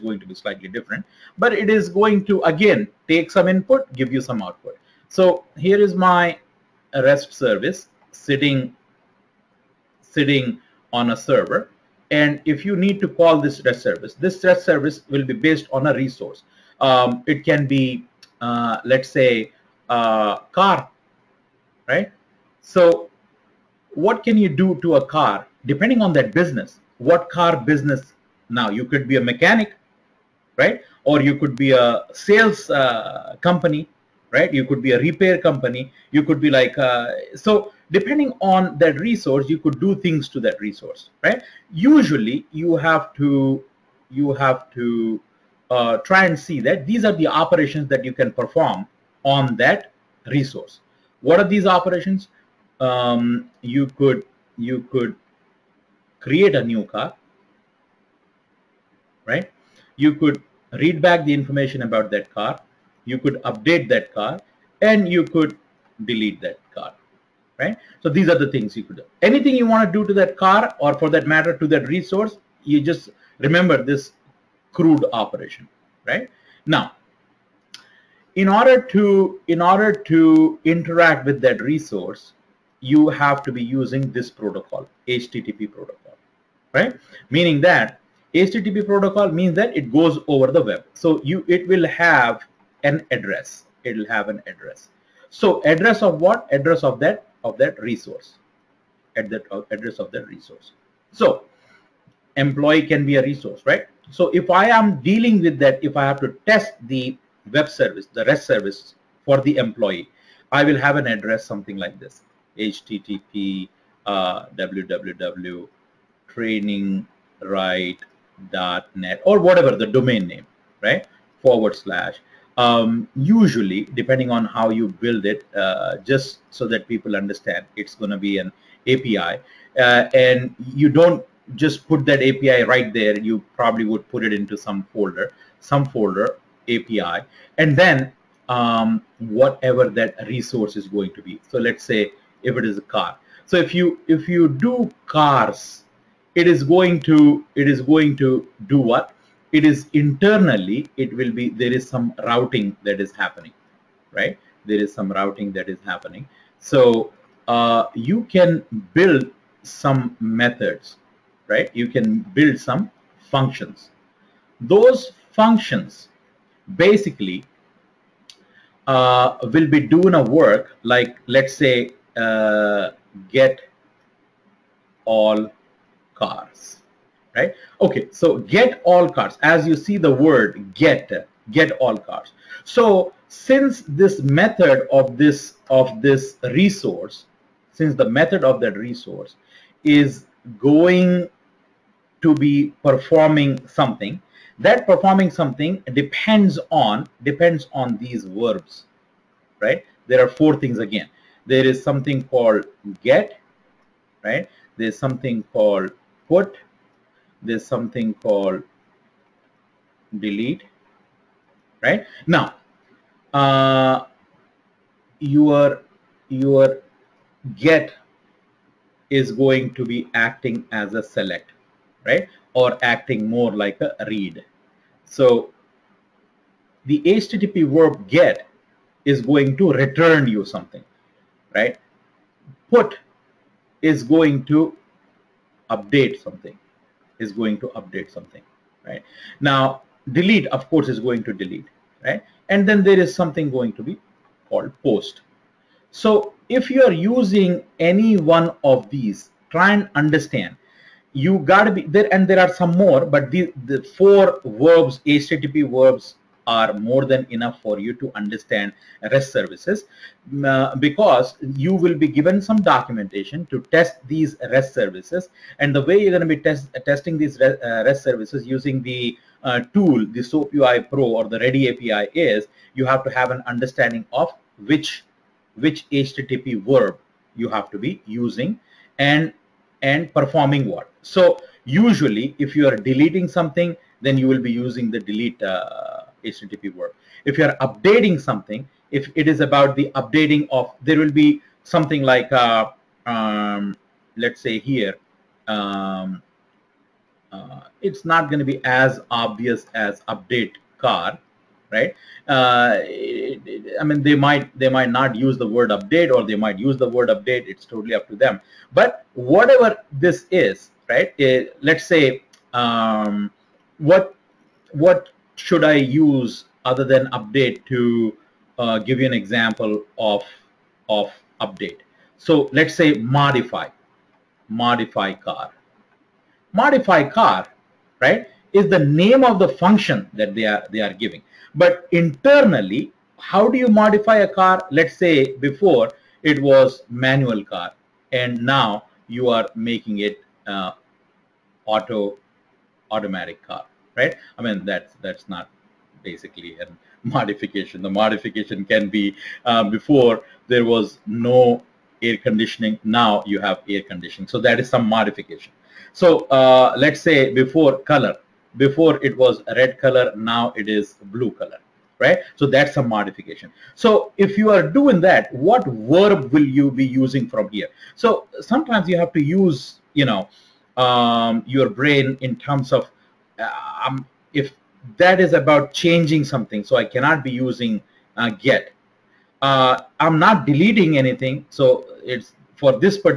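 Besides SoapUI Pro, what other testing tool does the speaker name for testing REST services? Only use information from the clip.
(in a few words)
Ready API.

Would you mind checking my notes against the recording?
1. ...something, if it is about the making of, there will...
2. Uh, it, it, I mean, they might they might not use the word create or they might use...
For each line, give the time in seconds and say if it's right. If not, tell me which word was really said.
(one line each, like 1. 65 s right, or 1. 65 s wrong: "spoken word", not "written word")
1. 288 s wrong: "updating", not "making"
2. 302 s wrong: "update", not "create".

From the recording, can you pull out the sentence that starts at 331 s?
But internally, how do you modify a car?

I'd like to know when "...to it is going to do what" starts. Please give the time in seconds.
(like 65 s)
147 s.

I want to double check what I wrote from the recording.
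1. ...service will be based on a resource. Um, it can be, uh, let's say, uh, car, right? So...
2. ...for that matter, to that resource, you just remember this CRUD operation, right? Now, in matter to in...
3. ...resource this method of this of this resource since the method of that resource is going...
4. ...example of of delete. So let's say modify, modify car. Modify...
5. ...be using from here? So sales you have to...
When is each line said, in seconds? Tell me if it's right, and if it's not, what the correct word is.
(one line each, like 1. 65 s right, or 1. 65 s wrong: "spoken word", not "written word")
1. 14 s right
2. 70 s wrong: "order", not "matter"
3. 183 s wrong: "since", not "resource"
4. 319 s wrong: "update", not "delete"
5. 366 s wrong: "sometimes", not "sales".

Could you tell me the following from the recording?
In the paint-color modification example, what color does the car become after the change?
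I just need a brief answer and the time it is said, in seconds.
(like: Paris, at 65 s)
Blue, at 361 s.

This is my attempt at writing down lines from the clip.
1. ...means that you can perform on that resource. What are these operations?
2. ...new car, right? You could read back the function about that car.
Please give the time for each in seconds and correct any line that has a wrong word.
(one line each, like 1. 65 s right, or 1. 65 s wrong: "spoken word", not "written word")
1. 47 s wrong: "operations", not "means"
2. 56 s wrong: "information", not "function".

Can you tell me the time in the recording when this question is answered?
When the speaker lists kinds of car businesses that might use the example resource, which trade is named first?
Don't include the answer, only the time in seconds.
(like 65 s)
29 s.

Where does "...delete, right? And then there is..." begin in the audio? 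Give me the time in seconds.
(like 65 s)
241 s.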